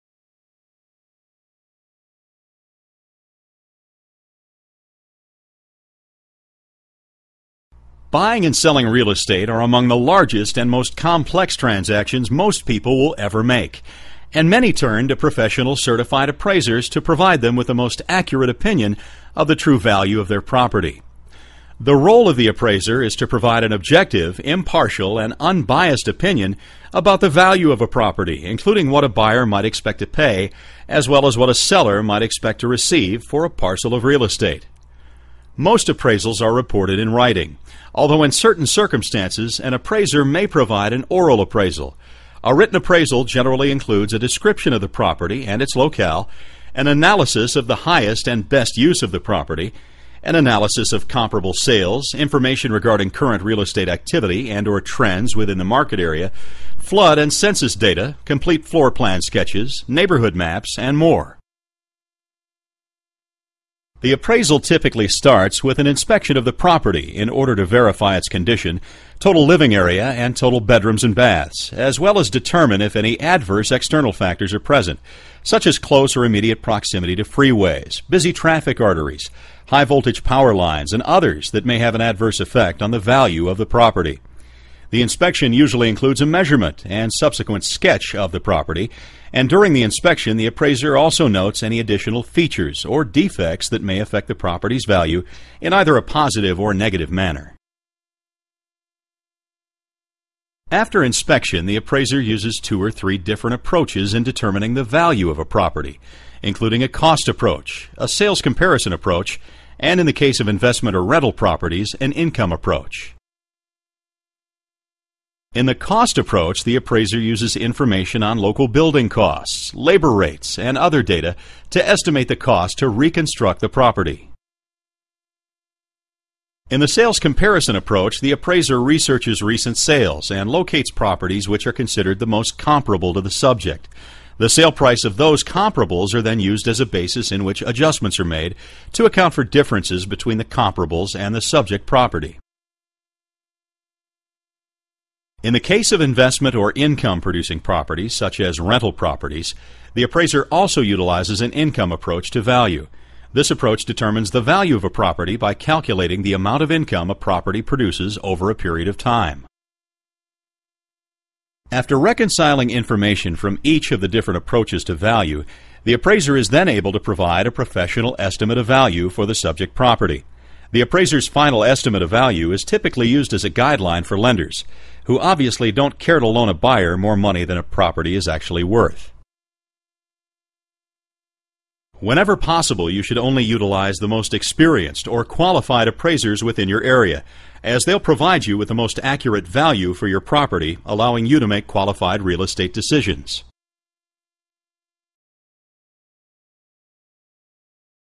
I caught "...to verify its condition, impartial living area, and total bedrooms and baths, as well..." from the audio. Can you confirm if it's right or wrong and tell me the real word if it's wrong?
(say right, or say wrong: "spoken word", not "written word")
wrong: "total", not "impartial".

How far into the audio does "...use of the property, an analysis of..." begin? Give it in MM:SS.
00:48.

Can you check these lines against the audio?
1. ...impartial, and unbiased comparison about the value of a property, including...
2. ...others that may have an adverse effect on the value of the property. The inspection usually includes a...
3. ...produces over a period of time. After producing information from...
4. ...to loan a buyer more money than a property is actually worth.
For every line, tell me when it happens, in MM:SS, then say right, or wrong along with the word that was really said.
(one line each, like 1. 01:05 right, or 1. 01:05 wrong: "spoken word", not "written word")
1. 00:24 wrong: "opinion", not "comparison"
2. 01:21 right
3. 02:37 wrong: "reconciling", not "producing"
4. 02:56 right.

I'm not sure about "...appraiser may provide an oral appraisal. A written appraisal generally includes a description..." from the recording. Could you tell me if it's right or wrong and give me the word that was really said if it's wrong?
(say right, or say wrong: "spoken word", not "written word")
right.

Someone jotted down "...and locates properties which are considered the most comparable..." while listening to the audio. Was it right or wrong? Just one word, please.
right.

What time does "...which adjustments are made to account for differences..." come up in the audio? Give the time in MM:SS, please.
02:17.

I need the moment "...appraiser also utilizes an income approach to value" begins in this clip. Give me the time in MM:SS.
02:30.